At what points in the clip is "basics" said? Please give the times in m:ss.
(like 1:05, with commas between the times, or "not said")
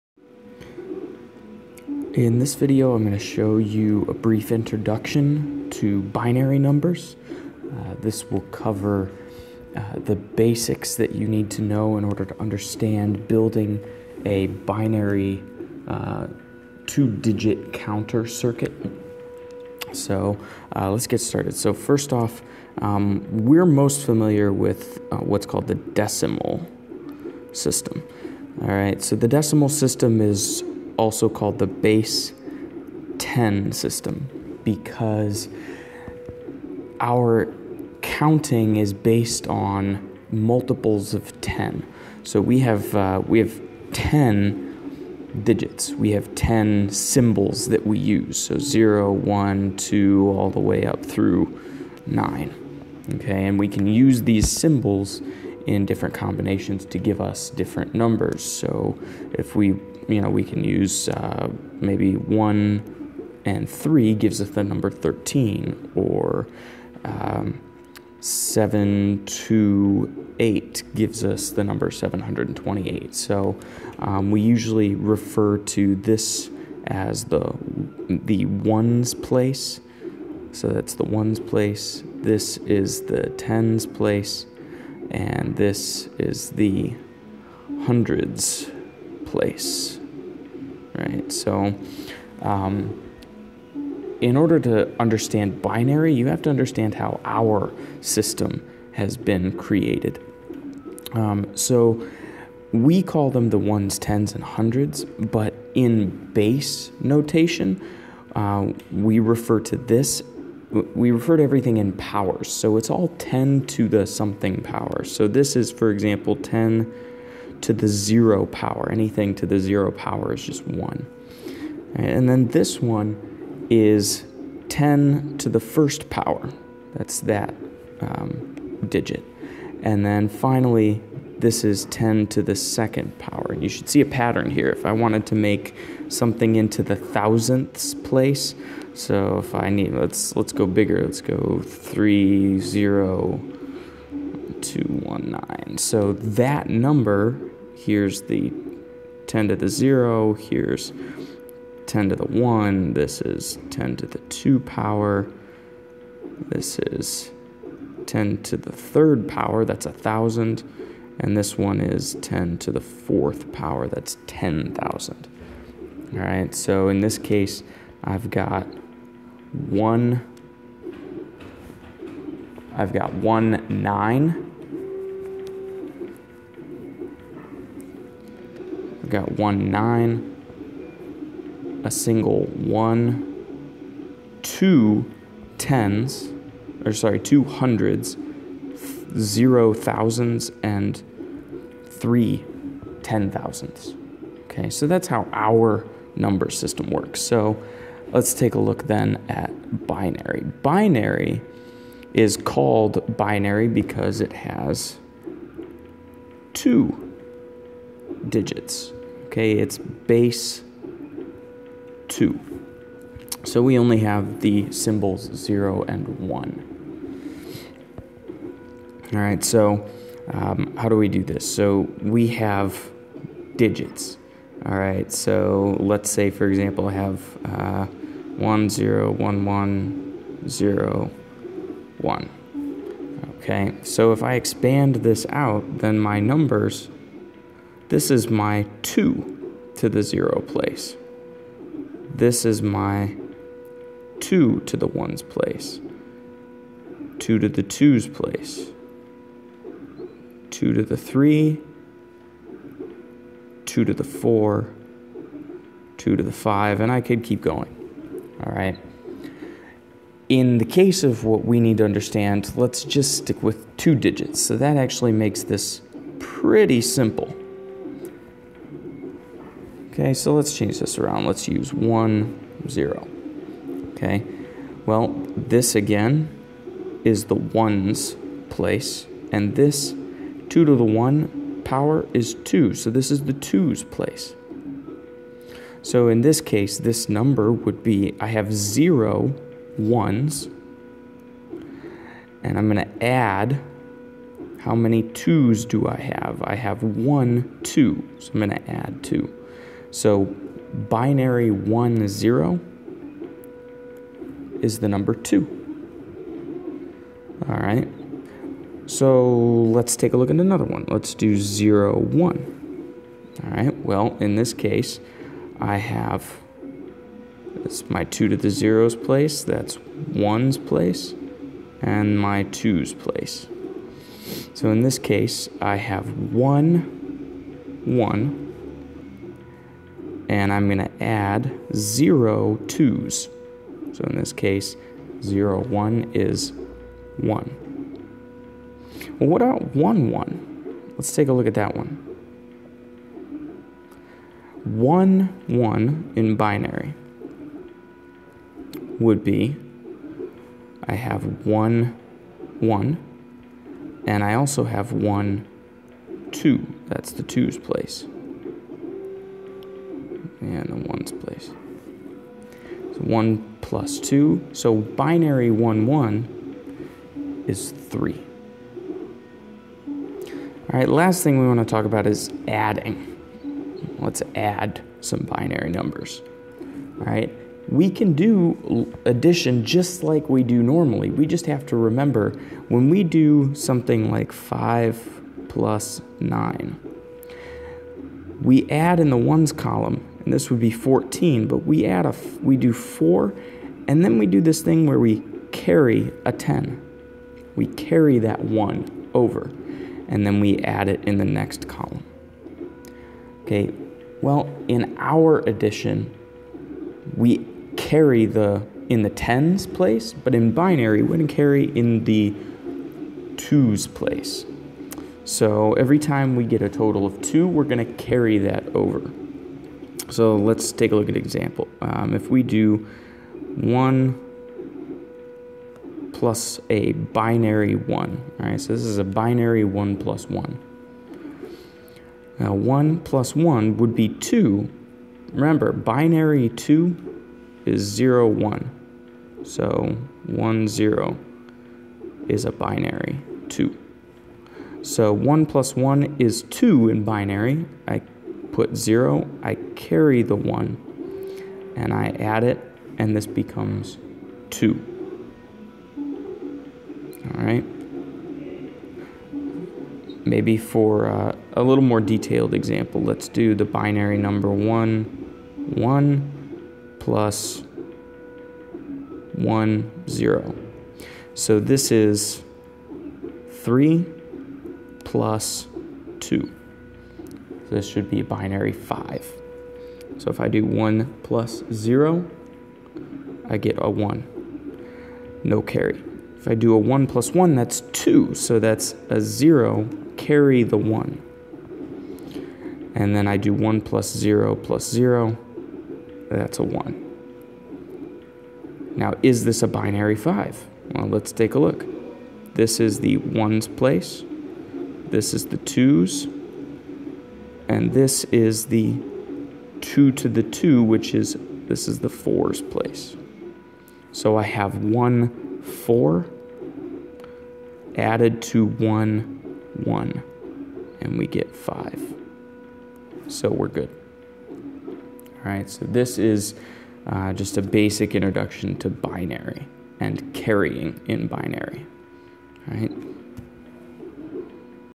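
0:10, 8:47.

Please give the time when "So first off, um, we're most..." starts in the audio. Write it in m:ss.
0:21.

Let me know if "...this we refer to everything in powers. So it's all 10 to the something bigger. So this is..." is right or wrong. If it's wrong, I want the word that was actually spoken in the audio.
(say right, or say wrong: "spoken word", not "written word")
wrong: "power", not "bigger".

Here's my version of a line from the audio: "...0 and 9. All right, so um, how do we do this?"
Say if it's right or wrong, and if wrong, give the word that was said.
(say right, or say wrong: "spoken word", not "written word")
wrong: "1", not "9".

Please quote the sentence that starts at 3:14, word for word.
Okay, so that's how our number system works.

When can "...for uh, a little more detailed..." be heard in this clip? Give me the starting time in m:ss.
7:40.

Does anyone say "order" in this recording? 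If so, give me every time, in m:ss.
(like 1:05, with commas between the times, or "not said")
0:12, 1:34.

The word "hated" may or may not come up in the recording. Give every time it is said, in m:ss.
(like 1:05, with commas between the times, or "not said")
not said.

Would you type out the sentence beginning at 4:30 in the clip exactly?
Okay, so let's change this around.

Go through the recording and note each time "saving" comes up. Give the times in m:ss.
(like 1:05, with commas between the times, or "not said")
not said.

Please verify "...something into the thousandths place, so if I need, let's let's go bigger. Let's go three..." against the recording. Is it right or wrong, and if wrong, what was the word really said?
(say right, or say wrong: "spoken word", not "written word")
right.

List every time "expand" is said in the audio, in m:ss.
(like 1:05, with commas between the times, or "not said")
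3:54.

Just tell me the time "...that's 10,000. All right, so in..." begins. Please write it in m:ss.
2:43.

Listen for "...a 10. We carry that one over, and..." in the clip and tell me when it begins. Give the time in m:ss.
6:36.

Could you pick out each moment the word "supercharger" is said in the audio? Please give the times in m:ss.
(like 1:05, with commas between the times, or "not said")
not said.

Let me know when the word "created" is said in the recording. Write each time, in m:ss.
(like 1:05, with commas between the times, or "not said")
1:39.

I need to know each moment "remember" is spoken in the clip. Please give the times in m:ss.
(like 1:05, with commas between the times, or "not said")
6:21, 7:15.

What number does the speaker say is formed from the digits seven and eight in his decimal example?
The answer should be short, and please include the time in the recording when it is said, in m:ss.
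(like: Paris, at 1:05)
728, at 1:11.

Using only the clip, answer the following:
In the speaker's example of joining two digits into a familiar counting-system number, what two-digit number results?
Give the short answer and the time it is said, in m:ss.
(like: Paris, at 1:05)
13, at 1:04.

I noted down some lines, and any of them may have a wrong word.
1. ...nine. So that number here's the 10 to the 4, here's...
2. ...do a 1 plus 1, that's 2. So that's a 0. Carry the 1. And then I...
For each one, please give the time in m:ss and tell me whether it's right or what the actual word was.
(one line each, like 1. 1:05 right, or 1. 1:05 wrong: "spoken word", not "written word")
1. 2:25 wrong: "0", not "4"
2. 8:06 right.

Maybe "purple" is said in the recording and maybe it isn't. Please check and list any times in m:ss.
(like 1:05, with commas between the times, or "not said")
not said.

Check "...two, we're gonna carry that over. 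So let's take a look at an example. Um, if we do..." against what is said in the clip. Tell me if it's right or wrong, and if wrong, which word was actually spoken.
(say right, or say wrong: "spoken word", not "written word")
right.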